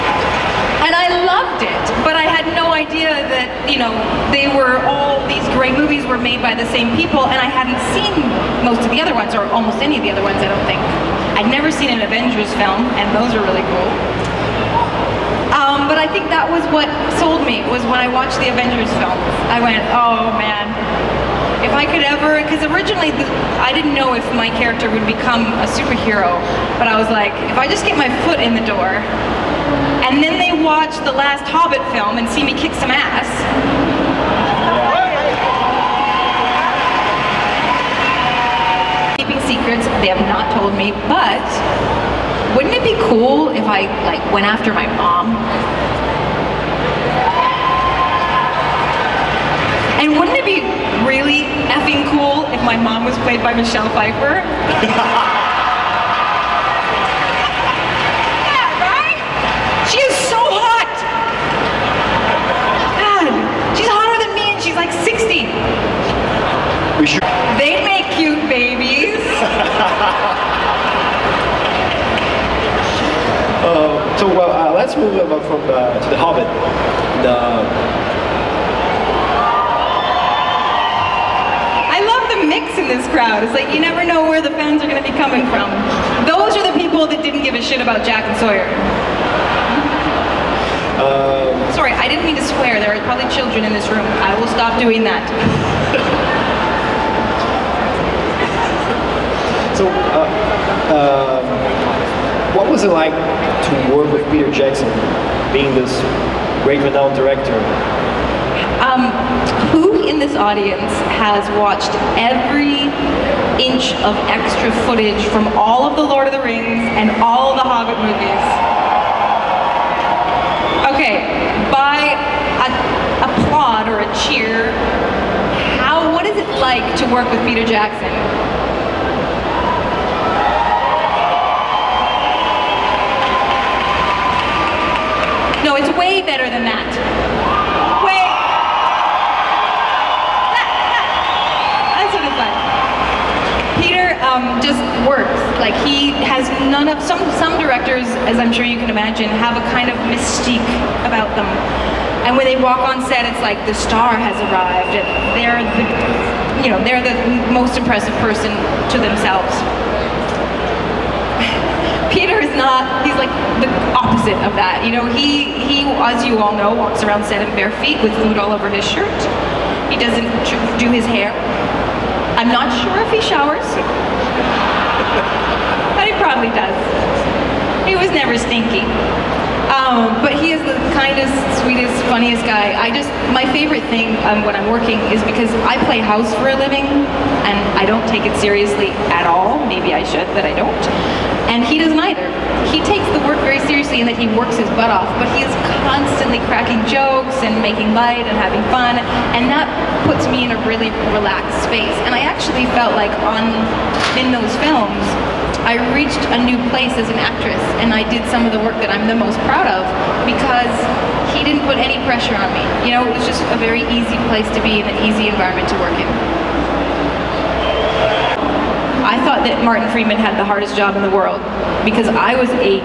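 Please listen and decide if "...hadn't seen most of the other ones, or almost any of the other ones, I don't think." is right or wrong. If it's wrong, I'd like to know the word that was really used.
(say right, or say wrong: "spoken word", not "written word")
right.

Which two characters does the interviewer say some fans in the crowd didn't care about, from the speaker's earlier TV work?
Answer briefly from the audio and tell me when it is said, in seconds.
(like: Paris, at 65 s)
Jack and Sawyer, at 88 s.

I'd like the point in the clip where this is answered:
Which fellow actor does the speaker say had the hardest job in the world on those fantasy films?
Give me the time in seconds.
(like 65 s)
219 s.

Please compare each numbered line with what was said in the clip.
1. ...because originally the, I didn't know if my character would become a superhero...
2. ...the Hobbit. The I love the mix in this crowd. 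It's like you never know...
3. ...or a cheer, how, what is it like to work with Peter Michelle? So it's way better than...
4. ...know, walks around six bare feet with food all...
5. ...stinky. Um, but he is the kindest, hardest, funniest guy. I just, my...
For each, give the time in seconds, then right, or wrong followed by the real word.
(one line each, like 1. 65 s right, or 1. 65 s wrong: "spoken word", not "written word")
1. 22 s right
2. 76 s right
3. 123 s wrong: "Jackson", not "Michelle"
4. 166 s wrong: "seven", not "six"
5. 178 s wrong: "sweetest", not "hardest".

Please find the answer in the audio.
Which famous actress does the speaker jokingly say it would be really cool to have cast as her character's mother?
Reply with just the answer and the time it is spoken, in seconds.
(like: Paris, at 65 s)
Michelle Pfeiffer, at 53 s.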